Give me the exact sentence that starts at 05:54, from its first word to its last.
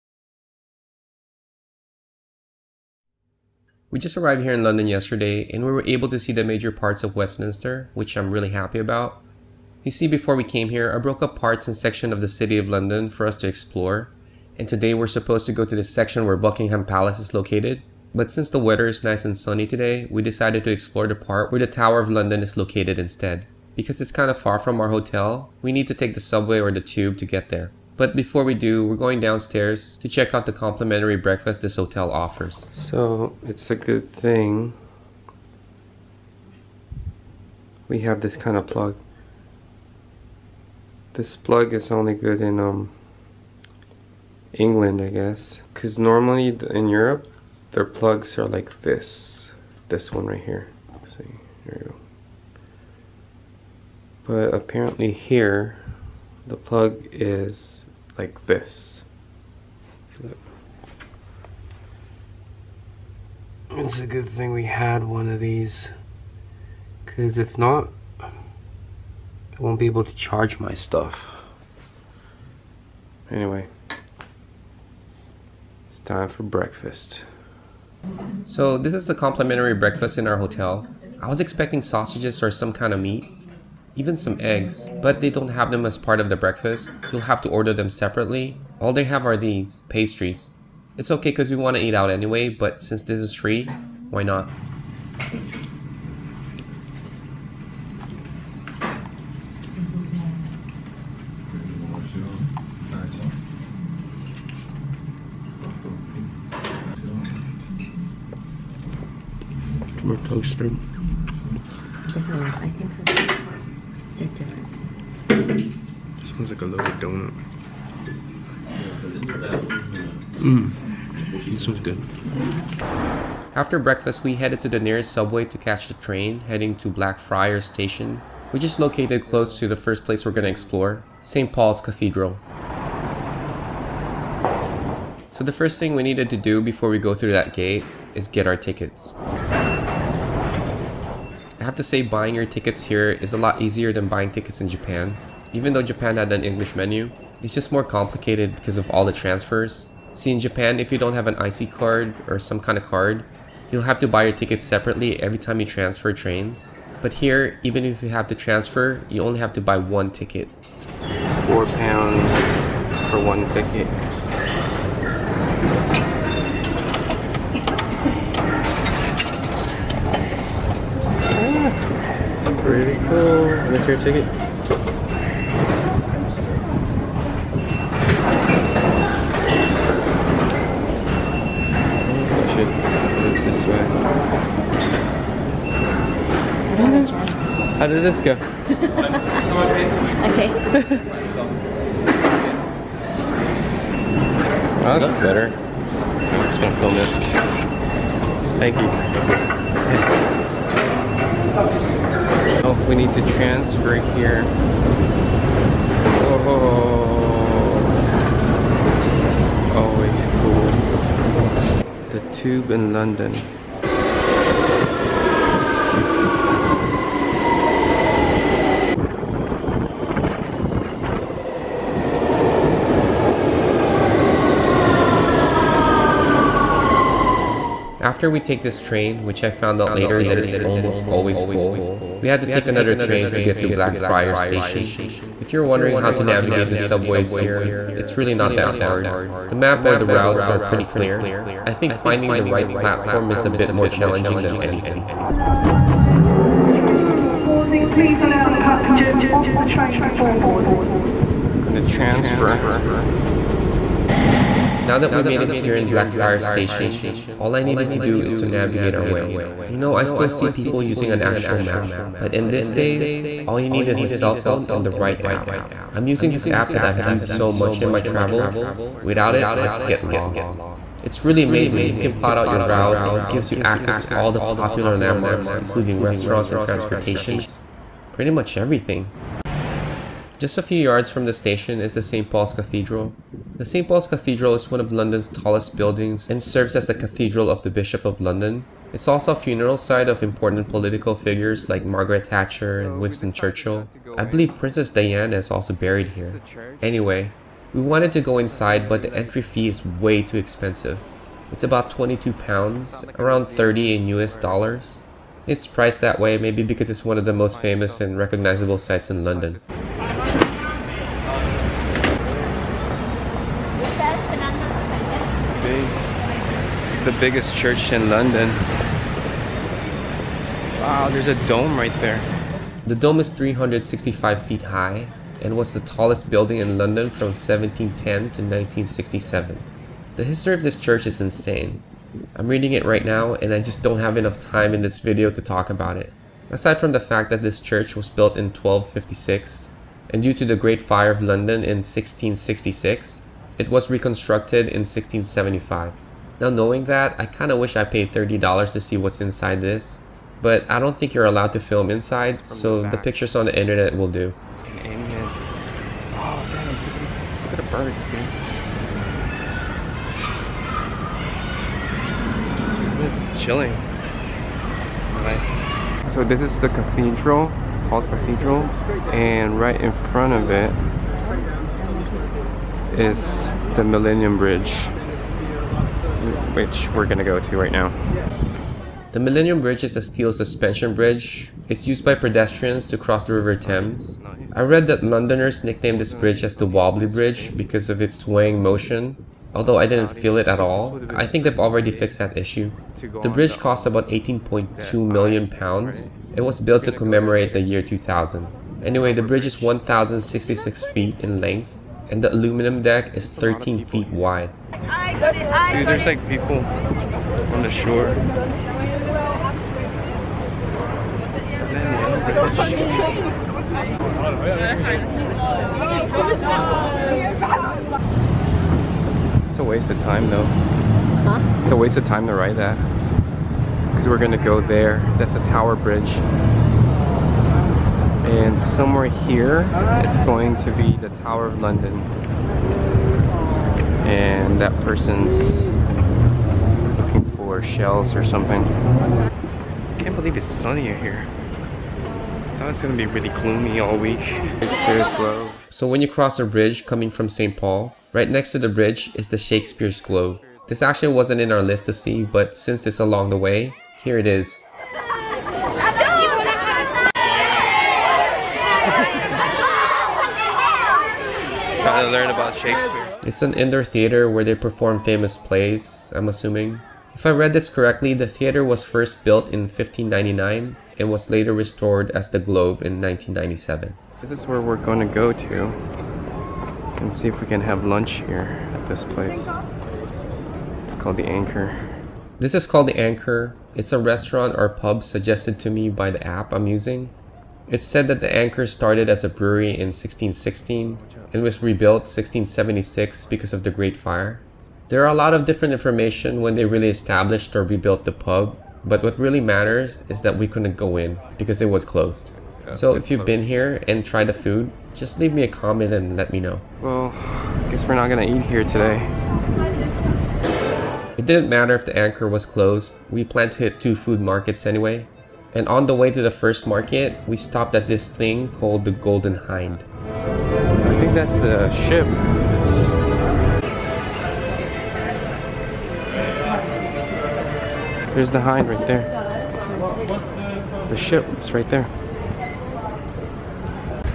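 in Oh damn, look at the birds, dude.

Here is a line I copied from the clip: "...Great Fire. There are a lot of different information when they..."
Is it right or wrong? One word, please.
right.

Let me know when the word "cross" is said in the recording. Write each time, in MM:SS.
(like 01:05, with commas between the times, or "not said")
06:22, 07:26.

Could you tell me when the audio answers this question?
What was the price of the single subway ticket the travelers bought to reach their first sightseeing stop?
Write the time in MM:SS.
02:41.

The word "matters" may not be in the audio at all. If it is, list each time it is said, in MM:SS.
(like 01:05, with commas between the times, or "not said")
08:19, 08:31.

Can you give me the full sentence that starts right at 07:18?
I can't believe it's sunny out here.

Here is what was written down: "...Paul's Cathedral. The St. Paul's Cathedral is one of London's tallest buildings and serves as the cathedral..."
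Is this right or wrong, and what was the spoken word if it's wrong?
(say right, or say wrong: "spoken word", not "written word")
right.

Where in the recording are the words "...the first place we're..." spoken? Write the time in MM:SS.
02:09.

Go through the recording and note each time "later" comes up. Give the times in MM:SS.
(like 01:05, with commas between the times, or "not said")
03:49, 07:51.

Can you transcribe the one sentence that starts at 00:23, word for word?
Because it's kind of far from our hotel, we need to take the subway or the tube to get there.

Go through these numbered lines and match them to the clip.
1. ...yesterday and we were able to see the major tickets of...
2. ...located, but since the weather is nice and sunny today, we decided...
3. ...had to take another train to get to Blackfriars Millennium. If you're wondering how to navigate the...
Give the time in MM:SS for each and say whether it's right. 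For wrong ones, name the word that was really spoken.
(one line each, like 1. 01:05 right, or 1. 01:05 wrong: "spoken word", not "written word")
1. 00:04 wrong: "parts", not "tickets"
2. 00:17 right
3. 03:52 wrong: "Station", not "Millennium".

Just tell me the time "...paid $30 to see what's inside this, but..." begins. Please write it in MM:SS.
05:47.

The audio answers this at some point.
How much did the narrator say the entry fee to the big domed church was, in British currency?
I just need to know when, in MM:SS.
05:01.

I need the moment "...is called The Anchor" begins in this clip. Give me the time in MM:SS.
08:02.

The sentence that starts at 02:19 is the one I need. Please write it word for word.
I have to say buying your tickets here is a lot easier than buying tickets in Japan.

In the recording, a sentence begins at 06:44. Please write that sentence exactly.
Dude, there's like people on the shore.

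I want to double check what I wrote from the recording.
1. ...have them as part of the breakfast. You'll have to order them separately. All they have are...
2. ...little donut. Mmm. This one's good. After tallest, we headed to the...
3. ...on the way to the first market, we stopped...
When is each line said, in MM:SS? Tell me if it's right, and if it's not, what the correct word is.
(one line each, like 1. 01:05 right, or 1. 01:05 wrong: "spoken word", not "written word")
1. 01:25 right
2. 01:56 wrong: "breakfast", not "tallest"
3. 08:35 right.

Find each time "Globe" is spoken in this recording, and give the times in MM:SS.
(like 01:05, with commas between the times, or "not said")
07:29, 07:52.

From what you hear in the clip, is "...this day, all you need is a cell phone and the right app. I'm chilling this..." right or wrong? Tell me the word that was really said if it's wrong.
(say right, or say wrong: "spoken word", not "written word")
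wrong: "using", not "chilling".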